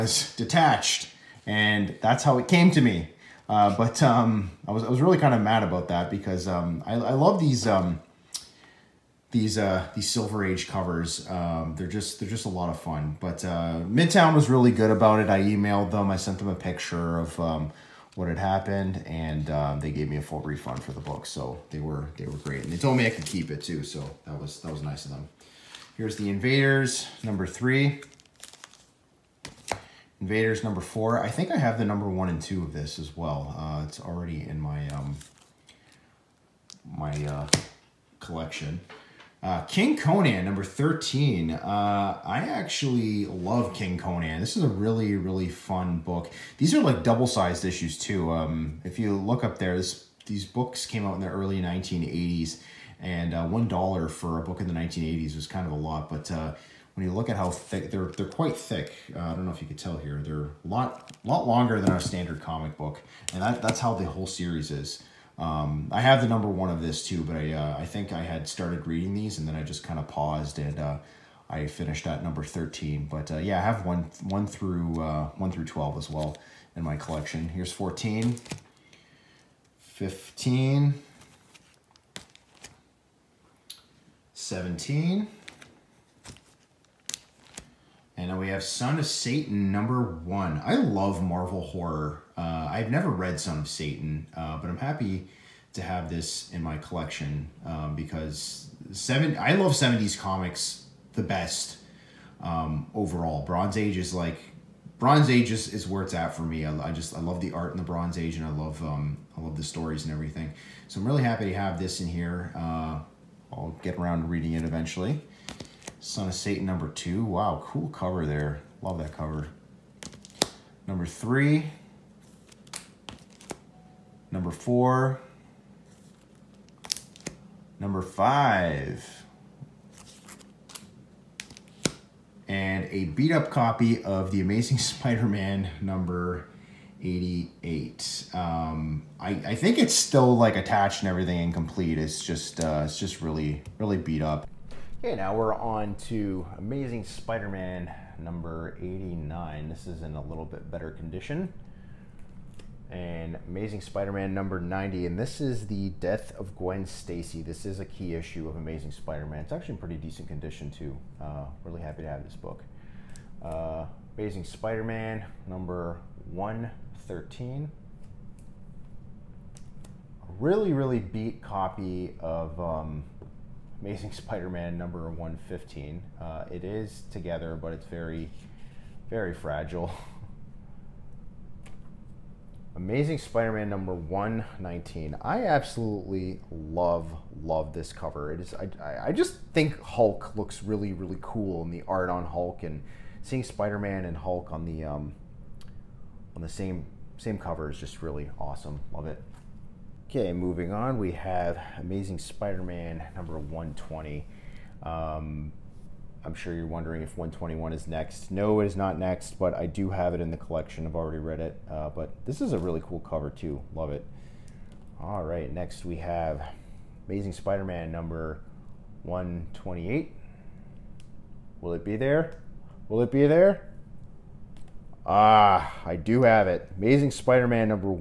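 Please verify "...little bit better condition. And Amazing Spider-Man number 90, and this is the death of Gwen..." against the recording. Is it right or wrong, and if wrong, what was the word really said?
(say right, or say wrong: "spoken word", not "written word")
right.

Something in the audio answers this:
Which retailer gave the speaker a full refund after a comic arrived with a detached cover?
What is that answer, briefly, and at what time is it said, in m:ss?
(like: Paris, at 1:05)
Midtown, at 0:13.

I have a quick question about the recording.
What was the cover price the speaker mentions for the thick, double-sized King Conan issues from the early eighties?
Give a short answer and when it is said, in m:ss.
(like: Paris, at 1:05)
one dollar, at 0:53.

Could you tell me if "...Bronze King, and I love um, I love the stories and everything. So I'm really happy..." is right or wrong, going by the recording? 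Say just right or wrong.
wrong.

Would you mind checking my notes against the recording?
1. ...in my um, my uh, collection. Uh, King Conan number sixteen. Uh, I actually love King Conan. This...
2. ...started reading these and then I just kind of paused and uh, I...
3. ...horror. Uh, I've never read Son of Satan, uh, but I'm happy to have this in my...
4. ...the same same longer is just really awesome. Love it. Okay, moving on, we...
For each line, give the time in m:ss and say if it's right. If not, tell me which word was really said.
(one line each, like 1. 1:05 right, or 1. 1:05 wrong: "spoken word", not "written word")
1. 0:34 wrong: "thirteen", not "sixteen"
2. 1:08 right
3. 1:31 right
4. 3:16 wrong: "cover", not "longer".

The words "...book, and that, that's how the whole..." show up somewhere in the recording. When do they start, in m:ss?
1:02.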